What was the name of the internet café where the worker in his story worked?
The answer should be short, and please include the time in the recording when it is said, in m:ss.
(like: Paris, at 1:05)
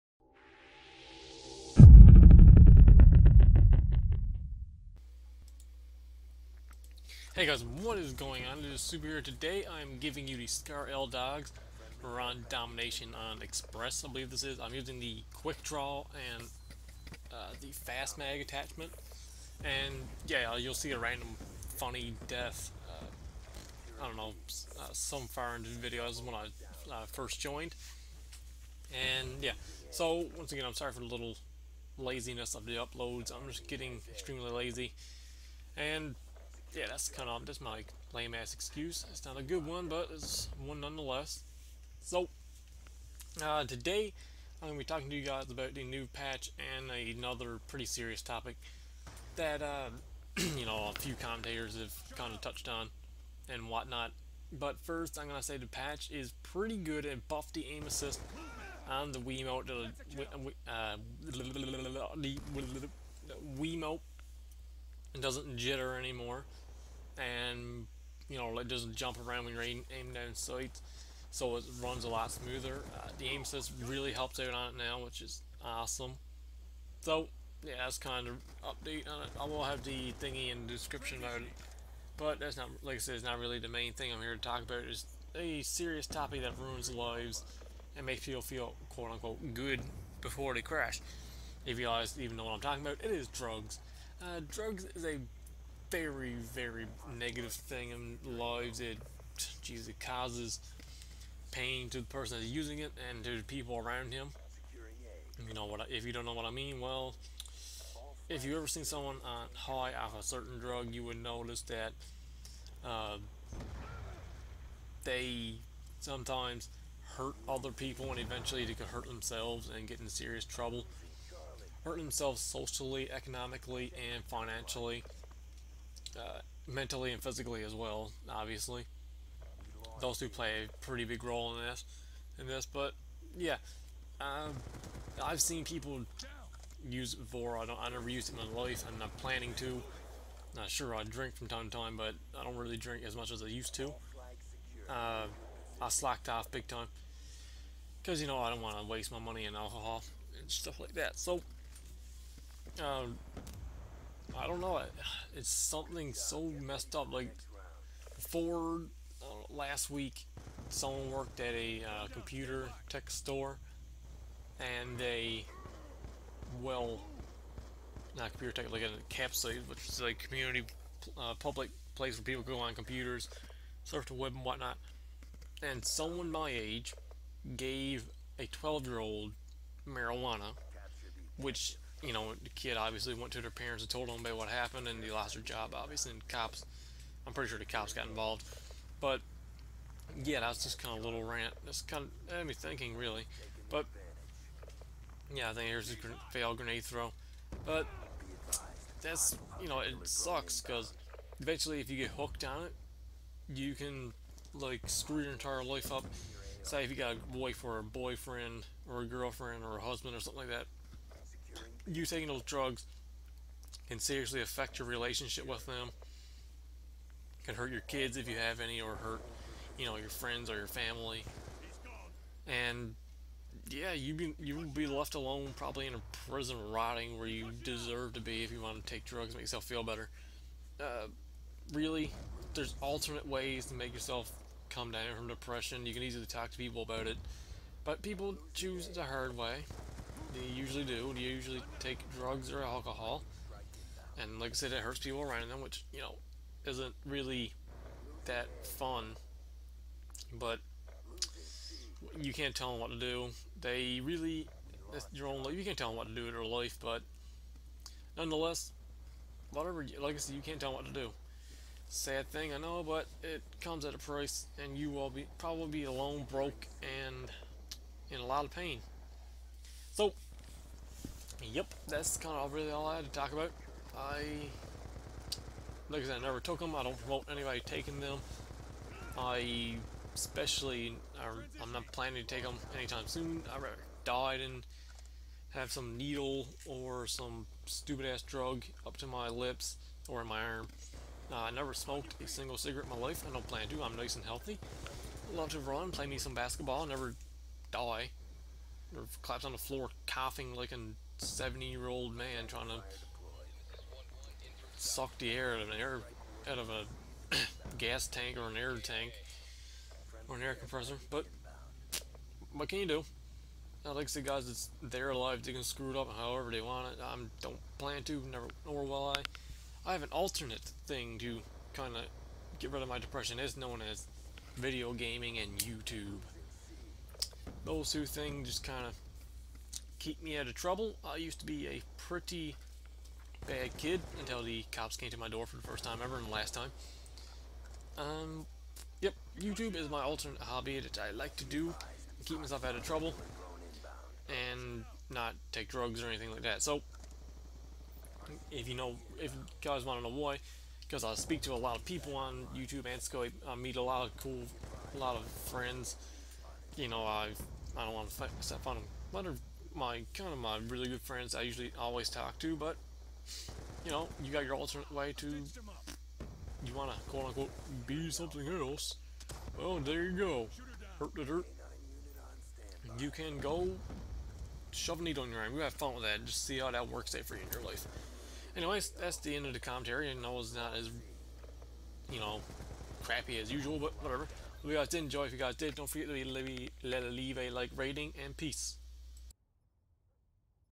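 a capsule, at 2:48.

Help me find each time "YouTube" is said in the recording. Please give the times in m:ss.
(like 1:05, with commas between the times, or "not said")
5:25, 5:39, 5:52.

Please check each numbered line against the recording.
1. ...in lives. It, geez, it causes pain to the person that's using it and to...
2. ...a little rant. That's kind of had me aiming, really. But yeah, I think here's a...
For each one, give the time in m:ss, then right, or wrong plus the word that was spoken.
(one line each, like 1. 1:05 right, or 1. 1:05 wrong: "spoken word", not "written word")
1. 1:37 right
2. 3:11 wrong: "thinking", not "aiming".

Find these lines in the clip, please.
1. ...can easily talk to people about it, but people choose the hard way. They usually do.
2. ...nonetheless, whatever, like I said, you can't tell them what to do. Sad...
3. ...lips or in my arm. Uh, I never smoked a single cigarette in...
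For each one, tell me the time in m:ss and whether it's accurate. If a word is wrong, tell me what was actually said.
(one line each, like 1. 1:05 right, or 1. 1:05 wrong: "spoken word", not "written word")
1. 3:55 right
2. 4:18 right
3. 4:49 right.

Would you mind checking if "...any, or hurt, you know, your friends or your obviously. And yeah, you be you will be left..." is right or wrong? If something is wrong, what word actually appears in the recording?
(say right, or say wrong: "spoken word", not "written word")
wrong: "family", not "obviously".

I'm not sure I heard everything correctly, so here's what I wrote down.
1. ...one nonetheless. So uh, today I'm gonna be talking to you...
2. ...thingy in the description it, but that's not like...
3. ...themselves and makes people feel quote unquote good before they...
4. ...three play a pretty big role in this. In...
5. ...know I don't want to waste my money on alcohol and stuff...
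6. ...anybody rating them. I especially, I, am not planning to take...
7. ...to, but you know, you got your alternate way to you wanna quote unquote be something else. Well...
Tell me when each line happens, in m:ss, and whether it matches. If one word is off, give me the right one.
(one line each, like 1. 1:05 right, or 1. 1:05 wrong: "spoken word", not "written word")
1. 0:40 right
2. 1:20 right
3. 1:26 wrong: "lives", not "themselves"
4. 2:10 wrong: "two", not "three"
5. 2:28 right
6. 4:37 wrong: "taking", not "rating"
7. 6:02 right.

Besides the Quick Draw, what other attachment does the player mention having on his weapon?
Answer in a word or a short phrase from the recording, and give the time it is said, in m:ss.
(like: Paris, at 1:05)
Fast Mag, at 0:17.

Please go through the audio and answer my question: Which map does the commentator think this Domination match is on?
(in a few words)
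Express.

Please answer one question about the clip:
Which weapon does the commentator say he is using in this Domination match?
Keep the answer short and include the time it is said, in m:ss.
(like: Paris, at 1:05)
Scar L, at 0:10.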